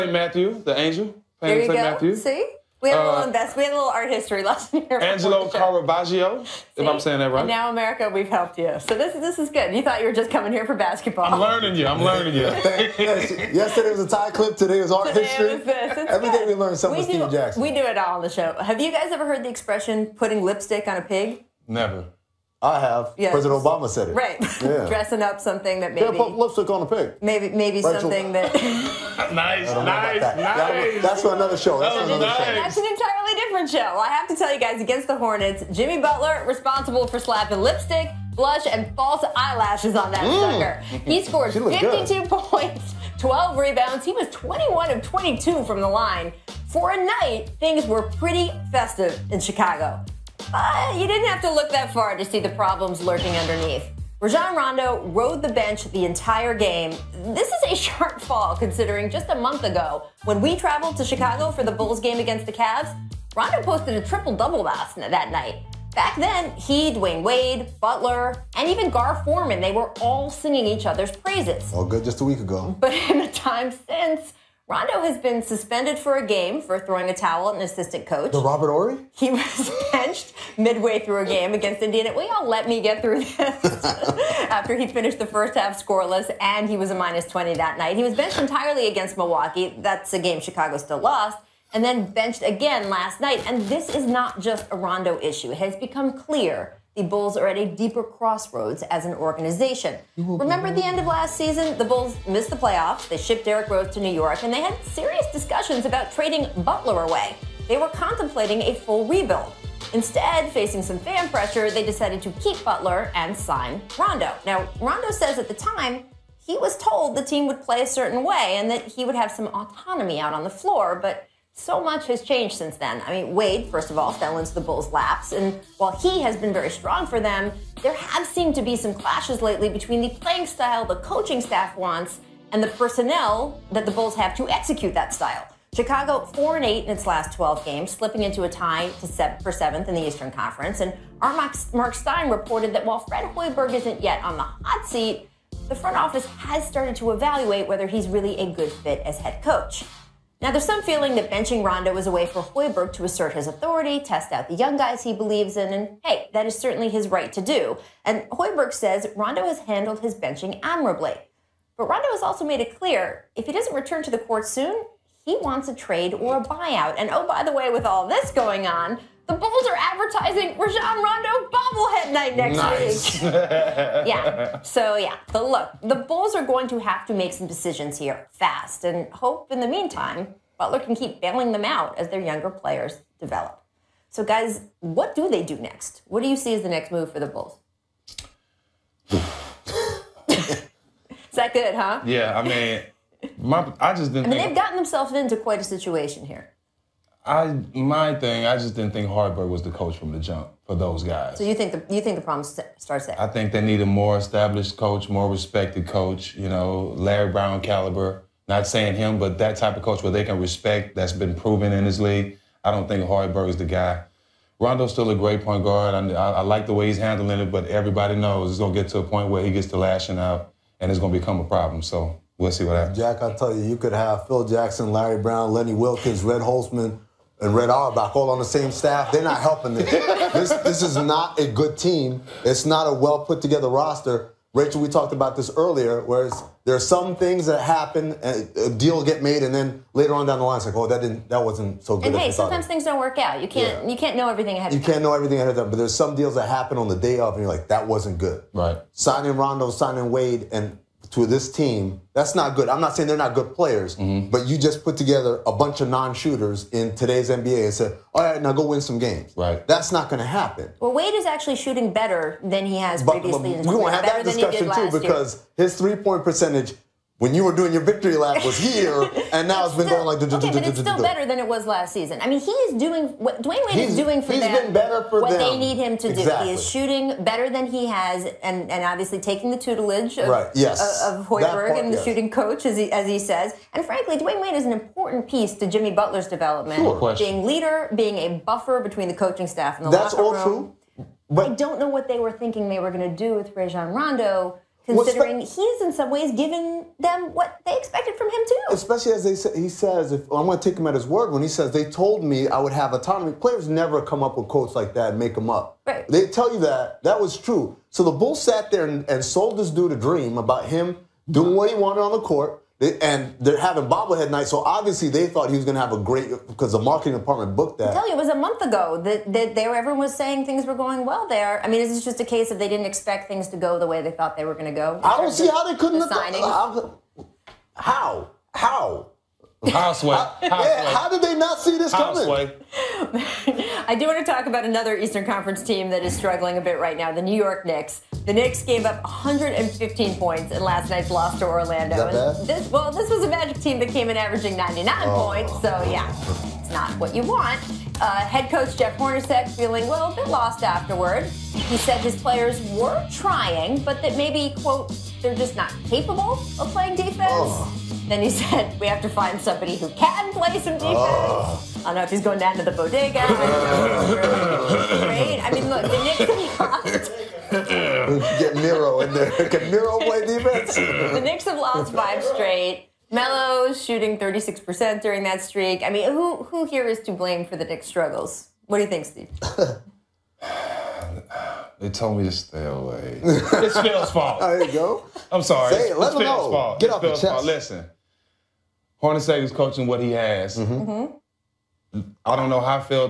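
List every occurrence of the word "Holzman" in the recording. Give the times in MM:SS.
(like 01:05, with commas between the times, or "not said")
03:46.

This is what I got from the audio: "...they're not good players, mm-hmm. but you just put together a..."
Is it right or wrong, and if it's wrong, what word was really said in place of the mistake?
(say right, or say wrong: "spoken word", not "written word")
right.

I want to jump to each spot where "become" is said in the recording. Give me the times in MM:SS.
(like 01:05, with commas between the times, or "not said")
01:35, 03:41.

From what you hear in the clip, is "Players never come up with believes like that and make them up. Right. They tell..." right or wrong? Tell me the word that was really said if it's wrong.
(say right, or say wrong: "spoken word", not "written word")
wrong: "quotes", not "believes".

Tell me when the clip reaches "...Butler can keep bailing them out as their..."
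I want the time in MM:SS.
03:00.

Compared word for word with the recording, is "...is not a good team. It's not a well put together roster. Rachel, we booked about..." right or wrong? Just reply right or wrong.
wrong.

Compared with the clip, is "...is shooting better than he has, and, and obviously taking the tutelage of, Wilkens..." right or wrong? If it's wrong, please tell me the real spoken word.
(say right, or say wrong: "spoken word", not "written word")
wrong: "Hoiberg", not "Wilkens".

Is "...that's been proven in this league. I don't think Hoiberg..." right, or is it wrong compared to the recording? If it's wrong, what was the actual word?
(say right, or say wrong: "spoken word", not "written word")
right.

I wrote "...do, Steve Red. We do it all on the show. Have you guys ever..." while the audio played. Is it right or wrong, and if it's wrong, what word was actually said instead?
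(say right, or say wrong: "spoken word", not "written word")
wrong: "Jackson", not "Red".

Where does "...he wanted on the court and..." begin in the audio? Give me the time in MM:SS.
05:11.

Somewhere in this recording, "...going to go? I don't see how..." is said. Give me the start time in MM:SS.
05:24.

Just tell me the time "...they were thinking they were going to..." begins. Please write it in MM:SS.
04:52.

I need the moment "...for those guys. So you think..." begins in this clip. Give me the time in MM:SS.
03:20.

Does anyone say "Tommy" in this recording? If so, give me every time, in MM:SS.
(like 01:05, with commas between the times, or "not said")
not said.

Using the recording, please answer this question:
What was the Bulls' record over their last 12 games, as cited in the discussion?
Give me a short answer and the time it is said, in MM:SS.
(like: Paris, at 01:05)
4 and 8, at 02:16.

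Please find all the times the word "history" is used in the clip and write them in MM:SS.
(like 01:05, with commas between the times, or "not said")
00:04, 00:15.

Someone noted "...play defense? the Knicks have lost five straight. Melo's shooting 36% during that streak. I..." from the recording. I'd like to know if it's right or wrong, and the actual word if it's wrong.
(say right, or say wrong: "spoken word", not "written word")
right.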